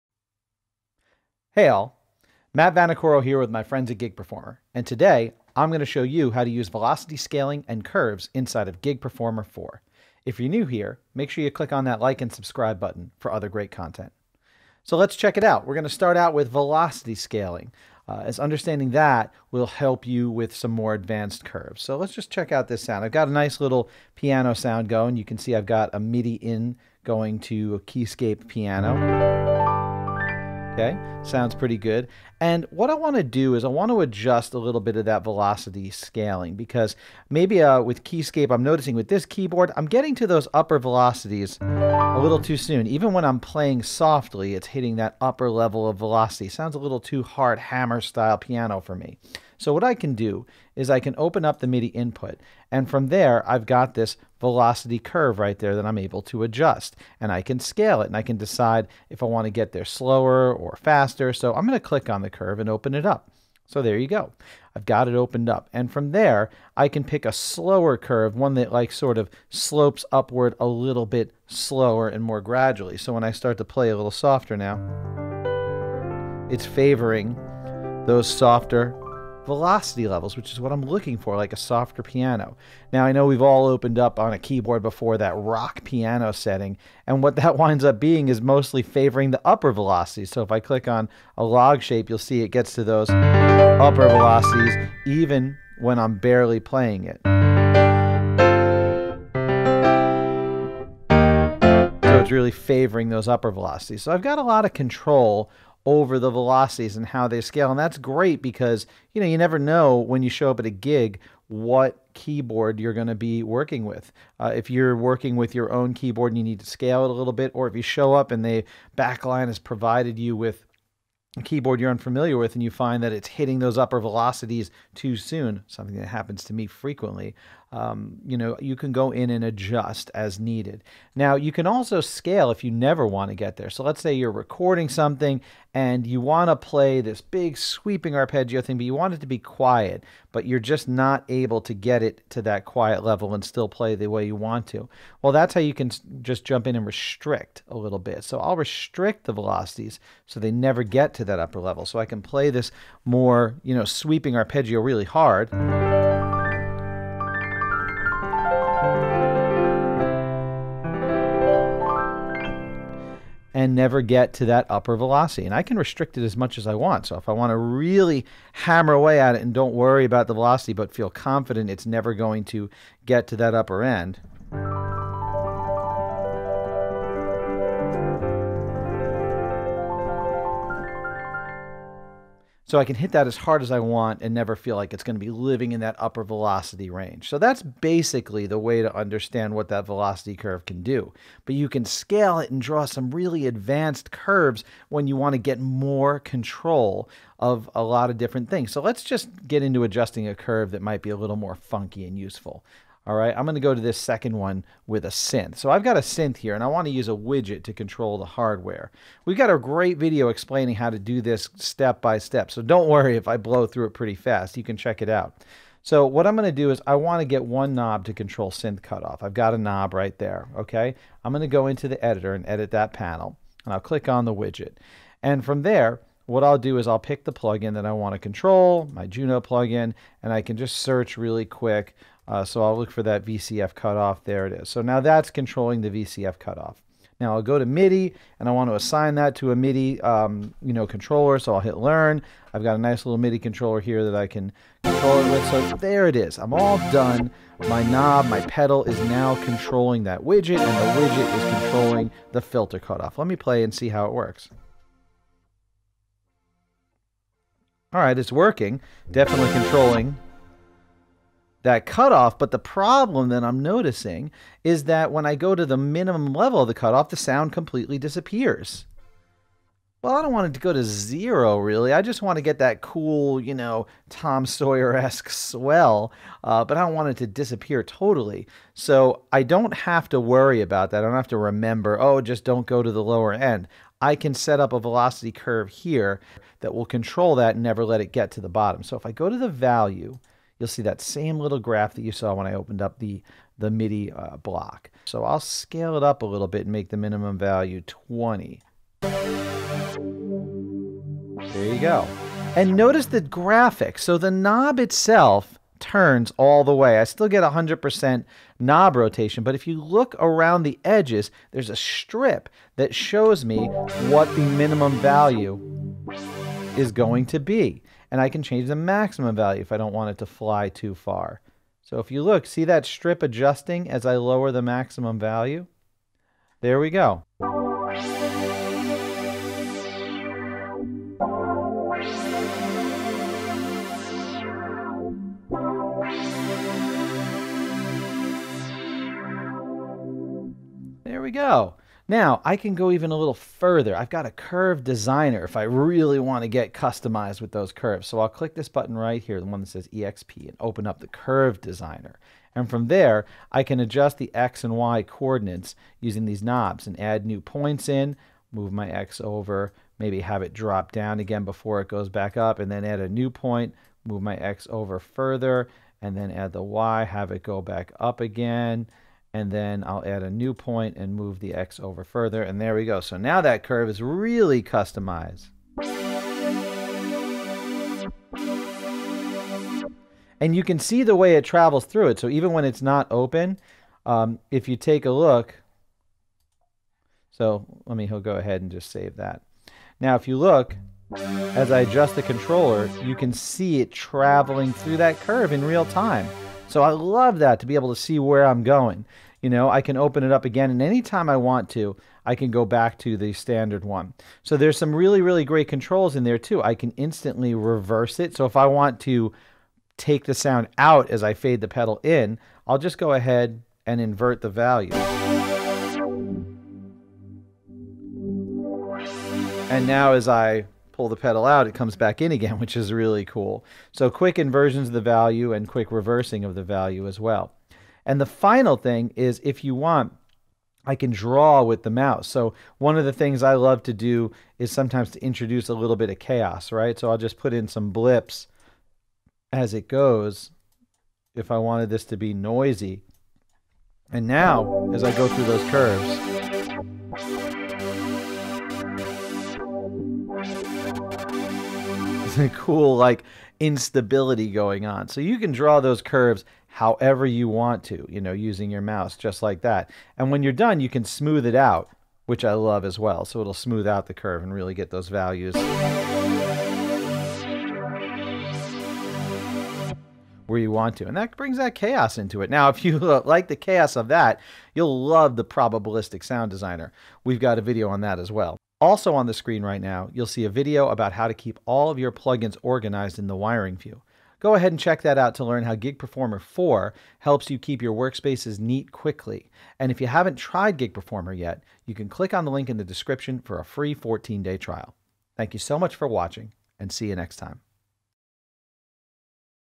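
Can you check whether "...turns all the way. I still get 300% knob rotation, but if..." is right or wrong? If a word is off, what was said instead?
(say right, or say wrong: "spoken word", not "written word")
wrong: "100", not "300".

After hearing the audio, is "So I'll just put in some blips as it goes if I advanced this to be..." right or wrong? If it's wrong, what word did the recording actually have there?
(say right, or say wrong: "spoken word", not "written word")
wrong: "wanted", not "advanced".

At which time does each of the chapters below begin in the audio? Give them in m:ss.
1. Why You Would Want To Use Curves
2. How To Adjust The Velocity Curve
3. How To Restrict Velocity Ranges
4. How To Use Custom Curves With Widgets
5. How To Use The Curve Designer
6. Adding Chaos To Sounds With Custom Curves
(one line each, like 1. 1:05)
1. 0:16
2. 0:56
3. 2:20
4. 3:30
5. 5:49
6. 7:19.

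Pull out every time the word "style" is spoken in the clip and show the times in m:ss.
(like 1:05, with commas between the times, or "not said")
0:48.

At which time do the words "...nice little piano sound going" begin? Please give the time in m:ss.
0:23.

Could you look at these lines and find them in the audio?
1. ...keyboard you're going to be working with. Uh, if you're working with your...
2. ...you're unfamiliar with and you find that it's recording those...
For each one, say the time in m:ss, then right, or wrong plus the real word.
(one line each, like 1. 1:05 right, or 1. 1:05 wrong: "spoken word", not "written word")
1. 1:52 right
2. 2:01 wrong: "hitting", not "recording".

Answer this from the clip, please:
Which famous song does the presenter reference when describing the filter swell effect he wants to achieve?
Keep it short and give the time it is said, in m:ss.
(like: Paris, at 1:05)
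Tom Sawyer, at 4:34.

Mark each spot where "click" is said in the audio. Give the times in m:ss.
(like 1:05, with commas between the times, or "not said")
0:11, 1:01, 1:30, 3:43, 5:48, 8:12.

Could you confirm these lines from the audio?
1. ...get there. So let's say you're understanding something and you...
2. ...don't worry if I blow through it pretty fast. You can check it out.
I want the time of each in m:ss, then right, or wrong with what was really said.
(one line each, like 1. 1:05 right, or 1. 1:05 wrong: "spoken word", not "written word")
1. 2:13 wrong: "recording", not "understanding"
2. 3:32 right.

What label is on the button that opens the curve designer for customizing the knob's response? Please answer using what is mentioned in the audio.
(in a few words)
EXP.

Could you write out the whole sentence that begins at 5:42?
Now I can go even a little further.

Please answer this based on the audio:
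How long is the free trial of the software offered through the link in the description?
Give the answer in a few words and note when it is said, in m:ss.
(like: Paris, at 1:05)
14 days, at 8:13.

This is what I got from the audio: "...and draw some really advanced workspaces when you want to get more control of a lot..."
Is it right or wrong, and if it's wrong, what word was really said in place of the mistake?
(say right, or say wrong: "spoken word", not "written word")
wrong: "curves", not "workspaces".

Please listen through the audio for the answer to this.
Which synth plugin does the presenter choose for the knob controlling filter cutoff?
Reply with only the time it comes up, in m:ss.
3:49.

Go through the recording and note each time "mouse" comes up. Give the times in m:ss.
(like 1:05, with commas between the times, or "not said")
7:11, 7:38.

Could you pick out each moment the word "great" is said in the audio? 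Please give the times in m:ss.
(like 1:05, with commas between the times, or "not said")
0:13, 1:47, 3:29, 6:45.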